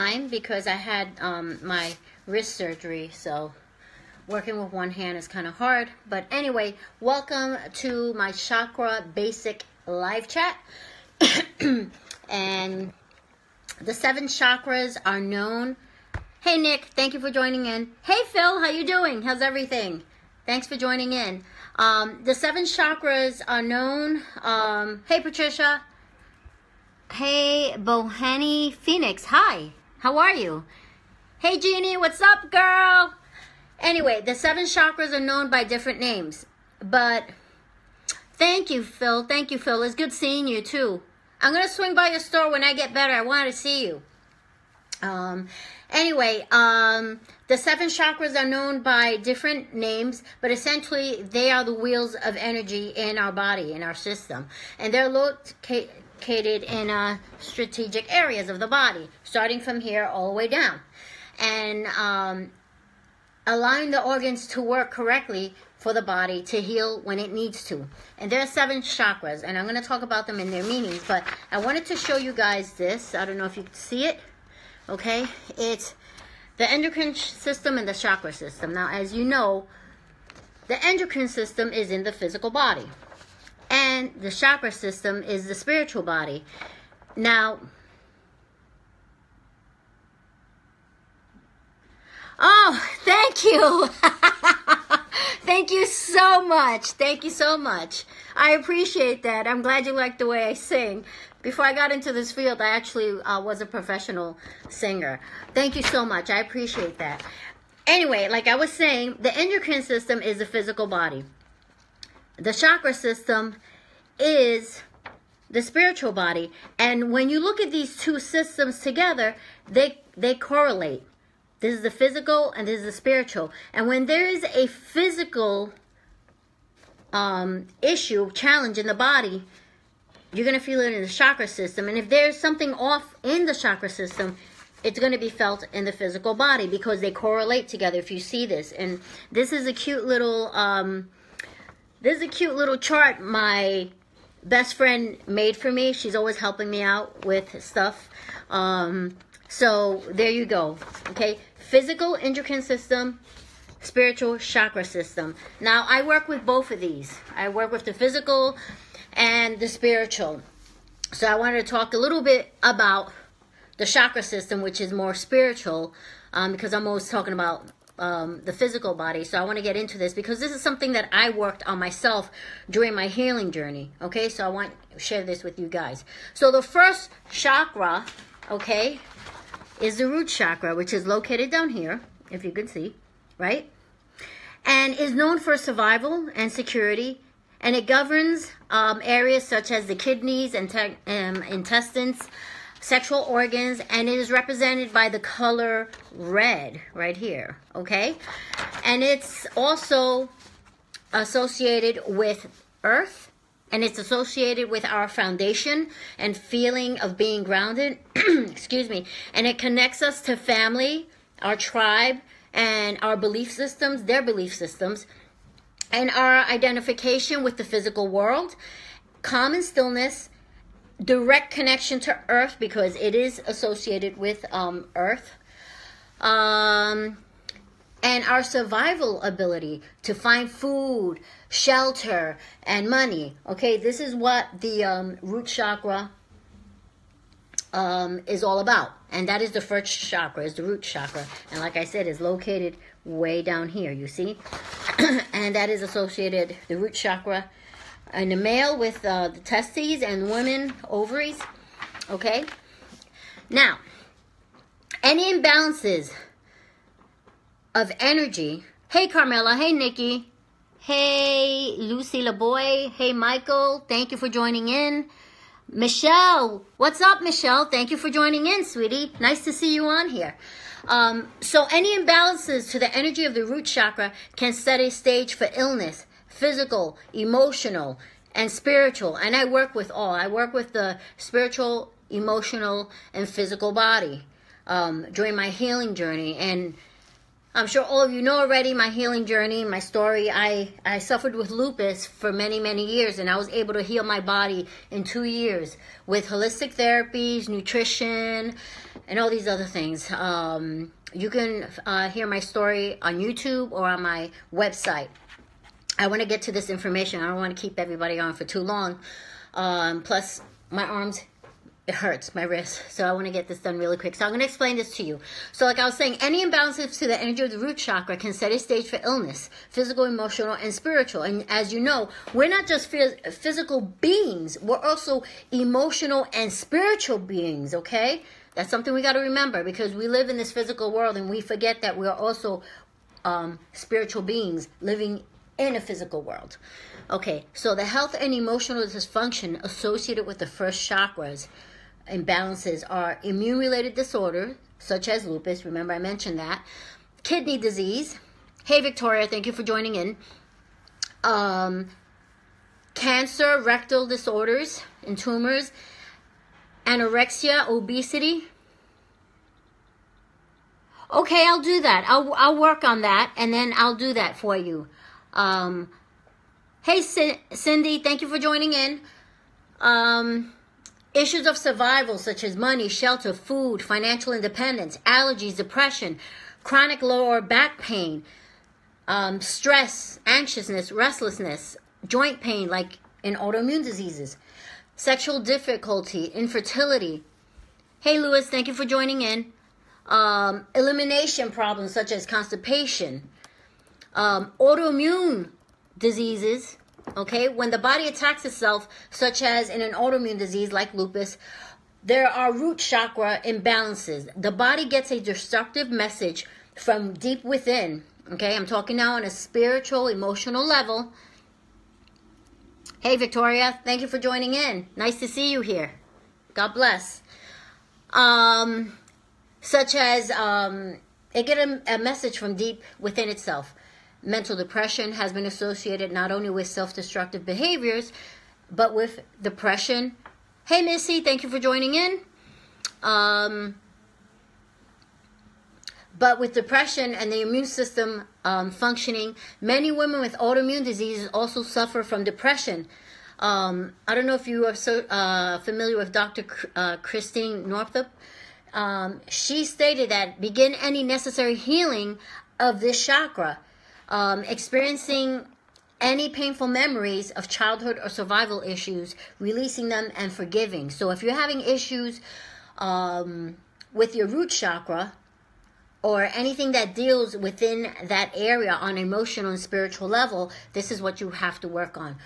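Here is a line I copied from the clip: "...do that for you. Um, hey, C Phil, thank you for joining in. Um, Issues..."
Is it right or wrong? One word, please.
wrong.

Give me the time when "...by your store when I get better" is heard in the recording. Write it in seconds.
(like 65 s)
41 s.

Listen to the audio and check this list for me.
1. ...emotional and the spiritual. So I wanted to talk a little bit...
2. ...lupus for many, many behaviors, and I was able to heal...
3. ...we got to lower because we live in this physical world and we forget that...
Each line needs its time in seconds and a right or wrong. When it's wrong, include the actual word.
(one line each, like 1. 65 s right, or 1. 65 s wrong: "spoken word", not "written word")
1. 157 s wrong: "physical", not "emotional"
2. 291 s wrong: "years", not "behaviors"
3. 328 s wrong: "remember", not "lower".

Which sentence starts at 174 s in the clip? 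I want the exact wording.
Okay, so I want to share this with you guys.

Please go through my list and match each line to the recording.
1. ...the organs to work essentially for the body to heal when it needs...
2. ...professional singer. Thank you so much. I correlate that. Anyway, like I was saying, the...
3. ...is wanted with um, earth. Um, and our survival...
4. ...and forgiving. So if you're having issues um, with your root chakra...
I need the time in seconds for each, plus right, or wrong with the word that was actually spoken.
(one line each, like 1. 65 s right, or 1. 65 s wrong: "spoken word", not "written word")
1. 63 s wrong: "correctly", not "essentially"
2. 103 s wrong: "appreciate", not "correlate"
3. 223 s wrong: "associated", not "wanted"
4. 460 s right.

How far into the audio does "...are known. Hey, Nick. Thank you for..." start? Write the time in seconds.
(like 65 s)
15 s.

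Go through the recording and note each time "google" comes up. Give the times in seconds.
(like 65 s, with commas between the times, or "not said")
not said.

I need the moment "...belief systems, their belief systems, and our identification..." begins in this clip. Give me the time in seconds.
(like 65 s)
213 s.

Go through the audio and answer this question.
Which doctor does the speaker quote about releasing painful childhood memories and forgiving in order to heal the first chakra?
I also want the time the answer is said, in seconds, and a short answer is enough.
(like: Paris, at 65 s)
Christine Northrup, at 446 s.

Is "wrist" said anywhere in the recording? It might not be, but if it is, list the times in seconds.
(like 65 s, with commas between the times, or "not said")
2 s, 312 s.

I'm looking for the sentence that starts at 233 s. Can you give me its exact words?
Okay, this is what the um, root chakra um, is all about.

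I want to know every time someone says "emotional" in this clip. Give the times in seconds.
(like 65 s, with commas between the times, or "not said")
277 s, 282 s, 320 s, 325 s, 338 s, 410 s, 468 s.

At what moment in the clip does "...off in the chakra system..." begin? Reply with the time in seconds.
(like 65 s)
132 s.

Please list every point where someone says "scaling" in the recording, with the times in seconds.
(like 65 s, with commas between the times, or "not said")
not said.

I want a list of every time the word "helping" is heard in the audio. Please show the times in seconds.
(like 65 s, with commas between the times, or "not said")
146 s.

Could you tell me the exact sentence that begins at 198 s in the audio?
And it's also associated with earth, and it's associated with our foundation and feeling of being grounded.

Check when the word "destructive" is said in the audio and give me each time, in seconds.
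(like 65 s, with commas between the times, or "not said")
405 s, 426 s.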